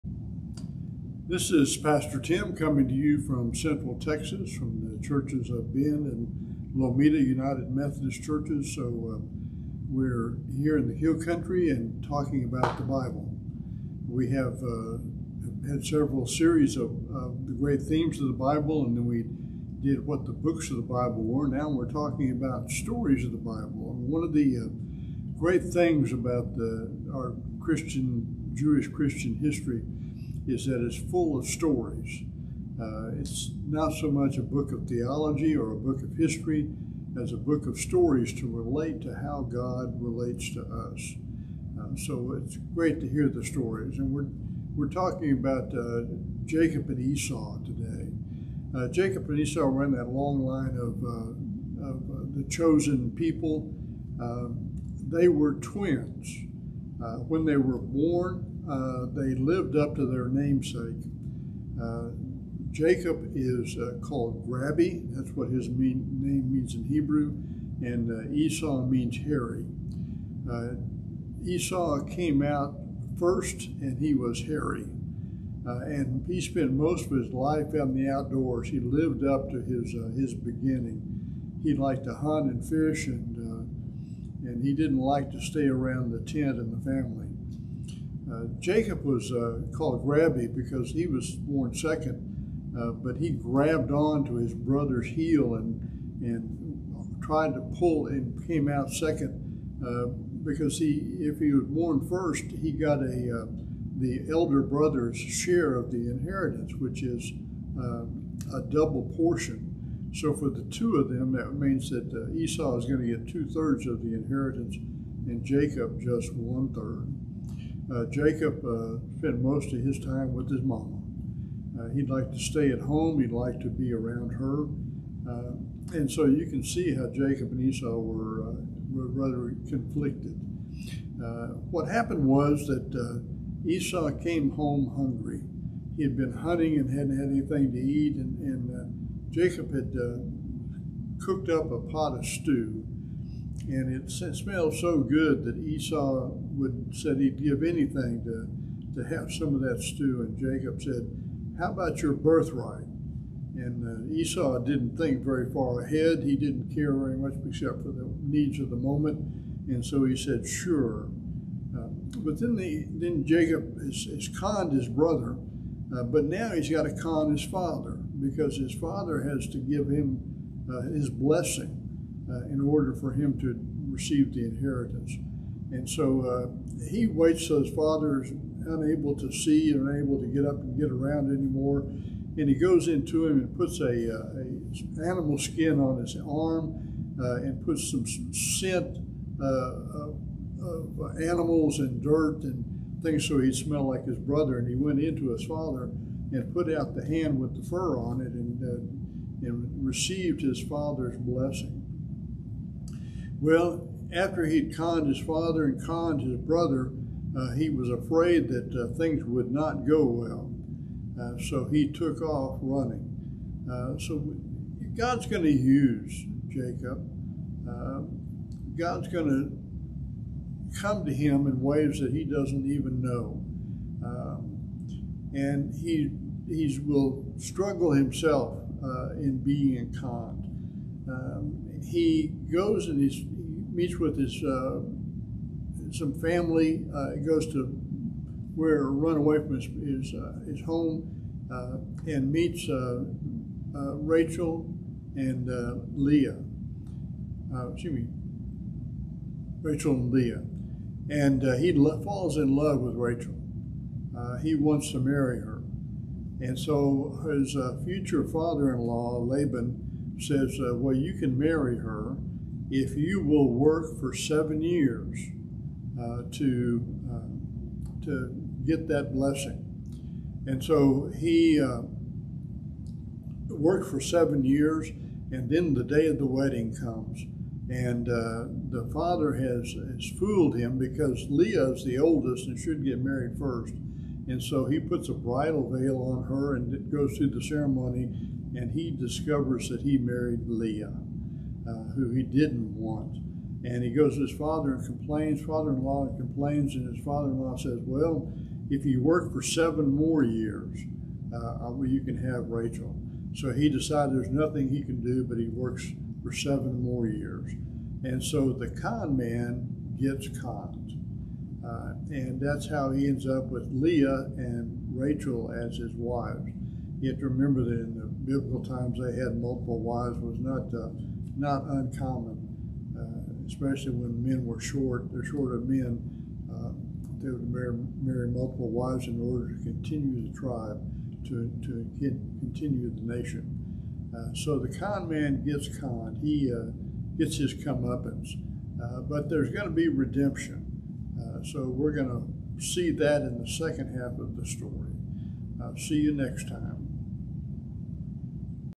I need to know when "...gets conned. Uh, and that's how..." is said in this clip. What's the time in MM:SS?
05:09.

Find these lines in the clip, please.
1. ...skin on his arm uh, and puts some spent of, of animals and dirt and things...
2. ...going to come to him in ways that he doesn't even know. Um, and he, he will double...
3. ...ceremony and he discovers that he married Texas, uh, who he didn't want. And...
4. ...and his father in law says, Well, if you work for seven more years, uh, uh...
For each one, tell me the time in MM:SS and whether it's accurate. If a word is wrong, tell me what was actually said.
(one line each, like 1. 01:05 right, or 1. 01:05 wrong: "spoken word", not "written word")
1. 03:05 wrong: "scent", not "spent"
2. 03:39 wrong: "struggle", not "double"
3. 04:47 wrong: "Leah", not "Texas"
4. 04:56 right.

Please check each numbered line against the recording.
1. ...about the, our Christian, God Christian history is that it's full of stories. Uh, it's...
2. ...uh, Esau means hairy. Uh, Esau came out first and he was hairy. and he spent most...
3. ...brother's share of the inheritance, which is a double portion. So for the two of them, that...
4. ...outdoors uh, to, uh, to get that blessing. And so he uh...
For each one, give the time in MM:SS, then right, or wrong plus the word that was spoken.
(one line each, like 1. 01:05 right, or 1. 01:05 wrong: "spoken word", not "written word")
1. 00:26 wrong: "Jewish", not "God"
2. 01:08 right
3. 01:44 right
4. 04:24 wrong: "years", not "outdoors".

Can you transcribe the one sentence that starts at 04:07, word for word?
excuse me, Rachel and Leah, and he lo- falls in love with Rachel.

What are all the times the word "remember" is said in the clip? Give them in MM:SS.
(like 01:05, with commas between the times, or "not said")
05:17.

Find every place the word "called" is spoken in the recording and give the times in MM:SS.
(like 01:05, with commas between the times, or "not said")
01:04, 01:29.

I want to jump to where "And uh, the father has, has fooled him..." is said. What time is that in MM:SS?
04:37.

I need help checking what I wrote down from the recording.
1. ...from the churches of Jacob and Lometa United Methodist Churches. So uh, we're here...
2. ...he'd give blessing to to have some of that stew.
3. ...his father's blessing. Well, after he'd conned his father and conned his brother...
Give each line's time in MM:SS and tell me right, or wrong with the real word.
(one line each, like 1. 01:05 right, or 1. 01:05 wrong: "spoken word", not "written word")
1. 00:04 wrong: "Bend", not "Jacob"
2. 02:27 wrong: "anything", not "blessing"
3. 03:20 right.